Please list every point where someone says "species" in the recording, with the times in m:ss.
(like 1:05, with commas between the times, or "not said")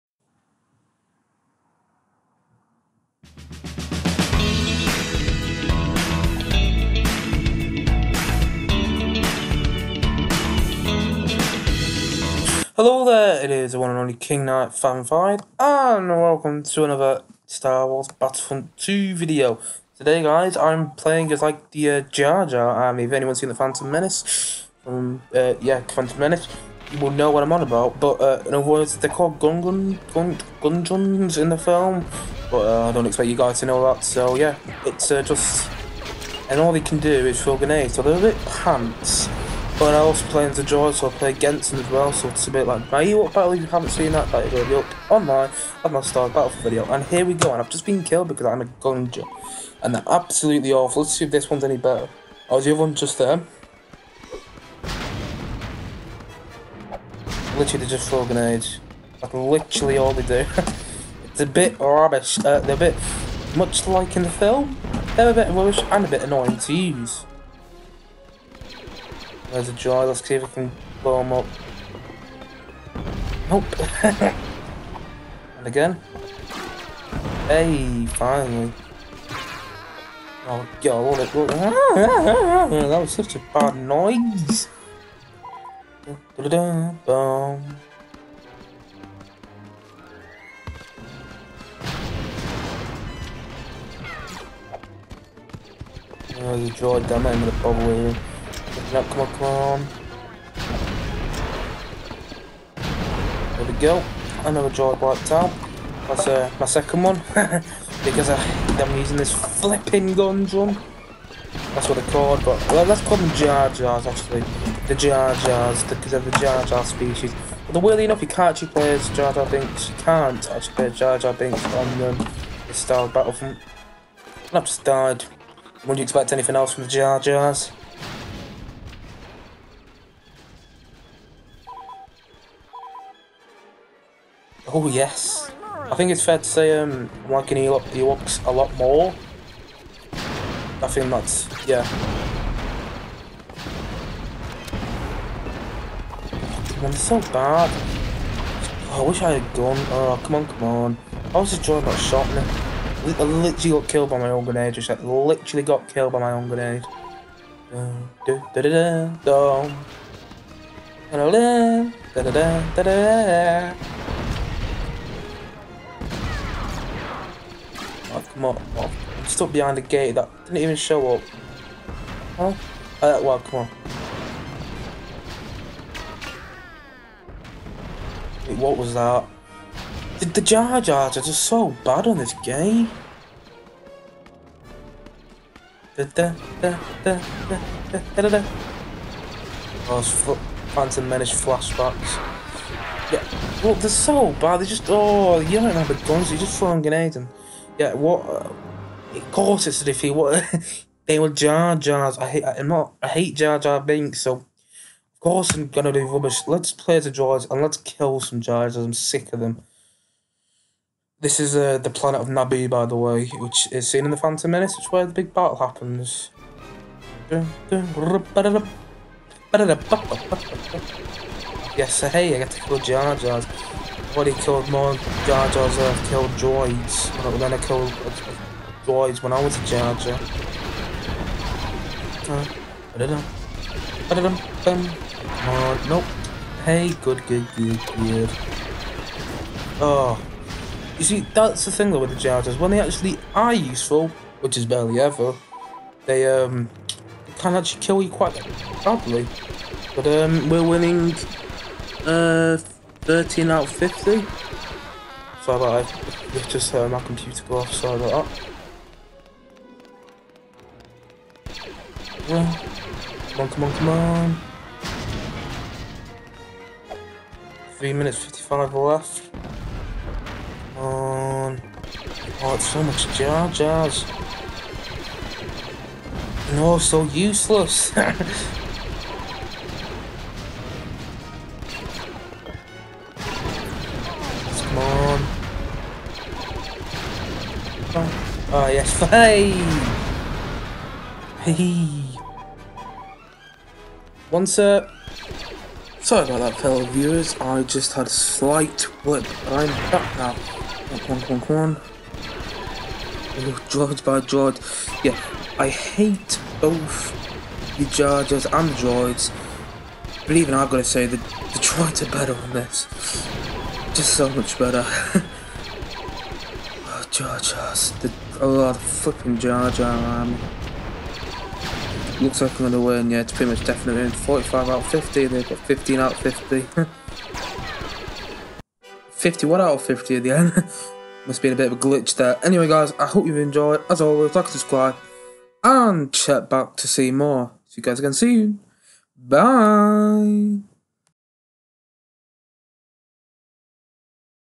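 1:56.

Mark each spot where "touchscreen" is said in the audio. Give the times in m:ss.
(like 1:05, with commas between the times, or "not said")
not said.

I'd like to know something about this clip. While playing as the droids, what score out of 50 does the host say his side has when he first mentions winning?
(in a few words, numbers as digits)
13.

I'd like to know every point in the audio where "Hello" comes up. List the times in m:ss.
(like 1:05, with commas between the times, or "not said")
0:12.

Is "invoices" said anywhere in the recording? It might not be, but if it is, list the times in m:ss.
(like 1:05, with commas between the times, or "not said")
not said.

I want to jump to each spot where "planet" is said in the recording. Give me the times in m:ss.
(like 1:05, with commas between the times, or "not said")
3:31.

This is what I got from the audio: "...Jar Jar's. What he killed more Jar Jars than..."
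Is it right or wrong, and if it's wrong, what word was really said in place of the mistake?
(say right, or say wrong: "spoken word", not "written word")
right.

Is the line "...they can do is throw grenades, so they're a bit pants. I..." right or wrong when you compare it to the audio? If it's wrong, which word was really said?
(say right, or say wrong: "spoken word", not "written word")
right.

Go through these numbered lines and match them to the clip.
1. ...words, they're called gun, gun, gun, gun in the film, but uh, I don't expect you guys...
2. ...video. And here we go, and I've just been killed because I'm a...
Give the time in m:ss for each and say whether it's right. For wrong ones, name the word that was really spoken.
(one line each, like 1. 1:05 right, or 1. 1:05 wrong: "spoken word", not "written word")
1. 0:28 right
2. 0:46 right.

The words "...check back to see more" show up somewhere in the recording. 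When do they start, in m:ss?
5:36.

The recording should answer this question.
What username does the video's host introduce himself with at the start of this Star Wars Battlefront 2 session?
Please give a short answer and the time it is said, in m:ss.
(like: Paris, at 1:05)
King Knight Fan 5, at 0:14.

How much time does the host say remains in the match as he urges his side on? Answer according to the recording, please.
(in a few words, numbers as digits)
3 minutes 55.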